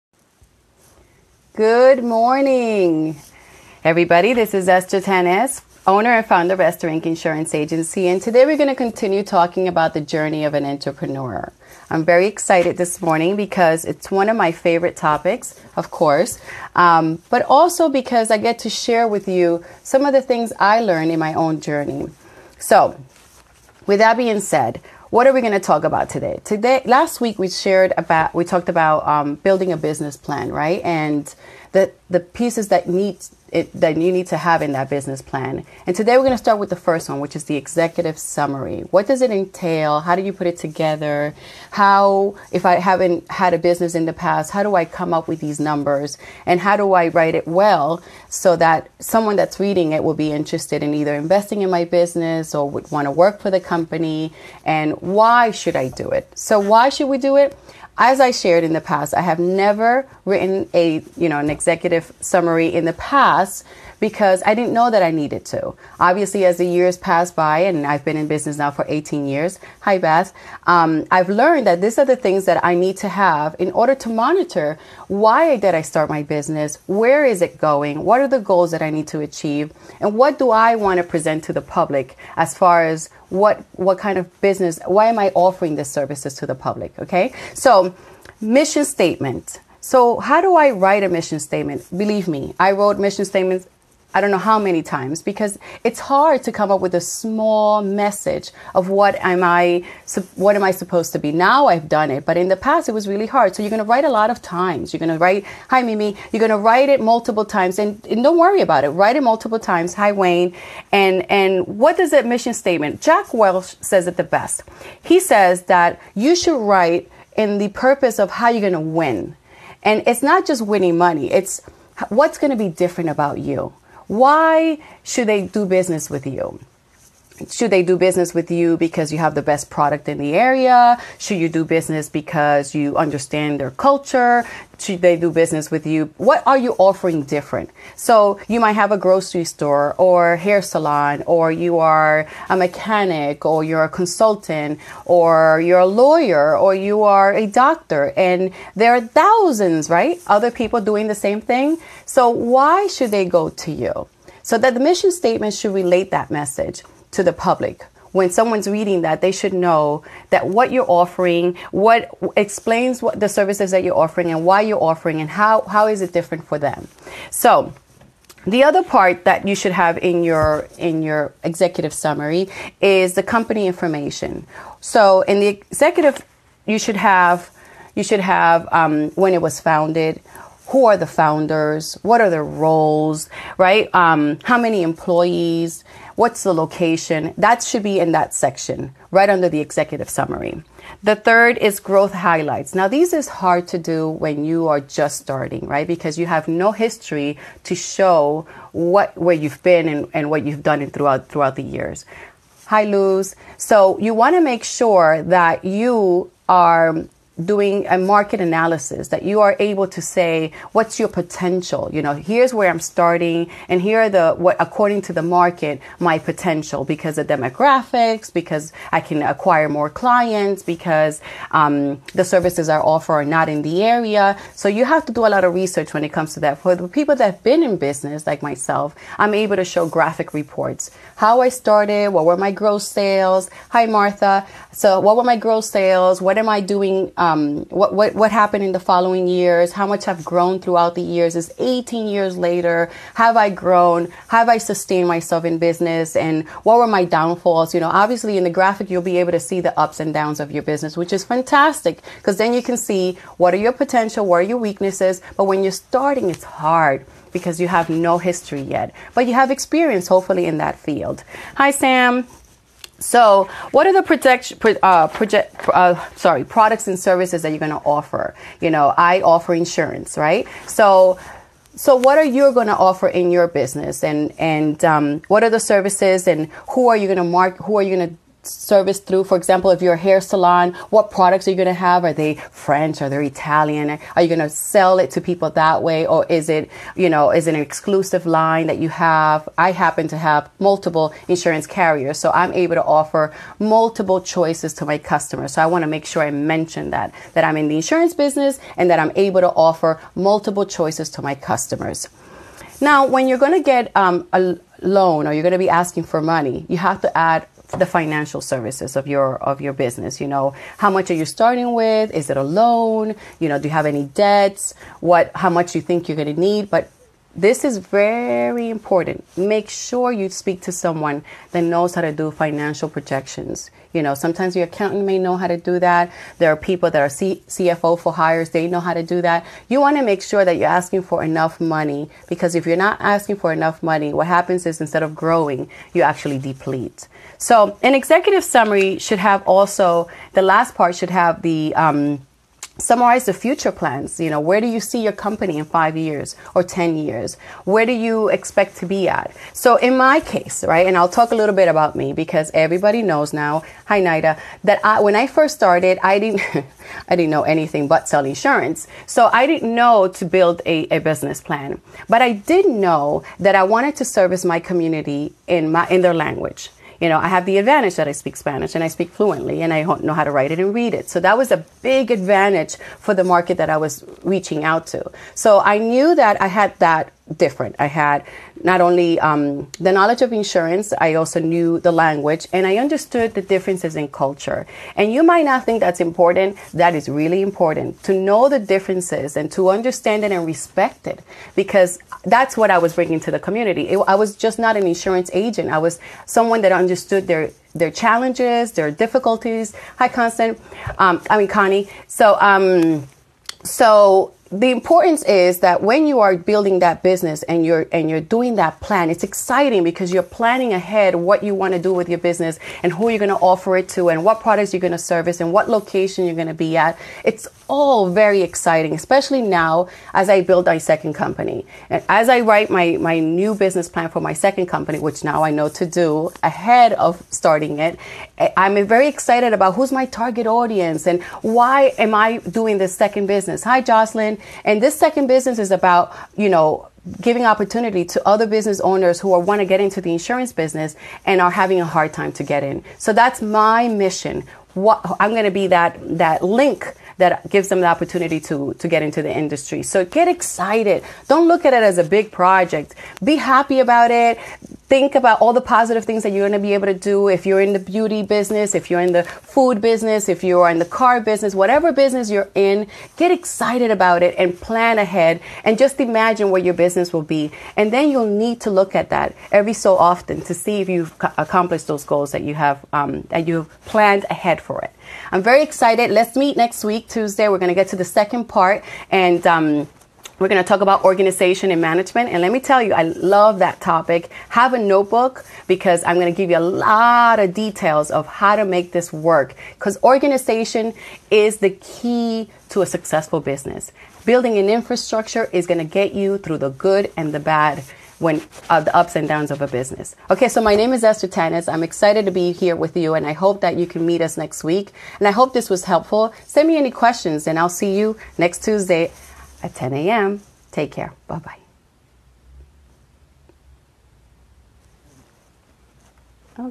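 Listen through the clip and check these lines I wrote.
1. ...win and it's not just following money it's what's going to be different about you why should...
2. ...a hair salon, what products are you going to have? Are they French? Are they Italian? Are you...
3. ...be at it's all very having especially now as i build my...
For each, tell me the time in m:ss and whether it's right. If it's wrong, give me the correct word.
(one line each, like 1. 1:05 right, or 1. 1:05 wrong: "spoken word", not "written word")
1. 1:58 wrong: "winning", not "following"
2. 4:39 right
3. 6:56 wrong: "exciting", not "having".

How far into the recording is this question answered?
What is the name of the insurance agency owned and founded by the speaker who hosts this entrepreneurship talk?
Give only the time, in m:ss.
0:06.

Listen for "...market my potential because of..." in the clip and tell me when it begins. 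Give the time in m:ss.
3:35.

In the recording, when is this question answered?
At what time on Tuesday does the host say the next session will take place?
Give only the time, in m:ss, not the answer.
8:29.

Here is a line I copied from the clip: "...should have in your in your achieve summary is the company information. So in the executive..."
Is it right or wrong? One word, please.
wrong.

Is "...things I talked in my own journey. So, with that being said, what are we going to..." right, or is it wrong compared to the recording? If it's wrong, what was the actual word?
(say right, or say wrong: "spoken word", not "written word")
wrong: "learned", not "talked".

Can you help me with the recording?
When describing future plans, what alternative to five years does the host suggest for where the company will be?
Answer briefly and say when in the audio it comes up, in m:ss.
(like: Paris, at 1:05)
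10, at 5:46.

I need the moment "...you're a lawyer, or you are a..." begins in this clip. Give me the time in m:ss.
2:25.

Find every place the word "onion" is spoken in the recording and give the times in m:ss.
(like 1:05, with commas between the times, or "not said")
not said.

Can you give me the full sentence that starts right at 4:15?
But when you're starting, it's hard because you have no history yet, but you have experience hopefully in that field.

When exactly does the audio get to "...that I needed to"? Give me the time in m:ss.
1:04.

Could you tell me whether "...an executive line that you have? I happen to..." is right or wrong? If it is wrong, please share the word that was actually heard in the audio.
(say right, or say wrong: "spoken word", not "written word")
wrong: "exclusive", not "executive".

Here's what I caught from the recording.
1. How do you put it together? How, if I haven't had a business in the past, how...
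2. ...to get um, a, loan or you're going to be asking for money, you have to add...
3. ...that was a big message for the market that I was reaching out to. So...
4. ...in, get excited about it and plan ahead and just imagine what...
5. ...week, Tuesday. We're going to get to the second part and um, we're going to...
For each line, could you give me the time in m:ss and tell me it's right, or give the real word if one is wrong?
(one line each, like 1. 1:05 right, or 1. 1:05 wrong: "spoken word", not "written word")
1. 0:39 right
2. 5:03 right
3. 6:11 wrong: "advantage", not "message"
4. 7:42 right
5. 7:56 right.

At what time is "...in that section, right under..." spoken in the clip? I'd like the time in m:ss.
3:07.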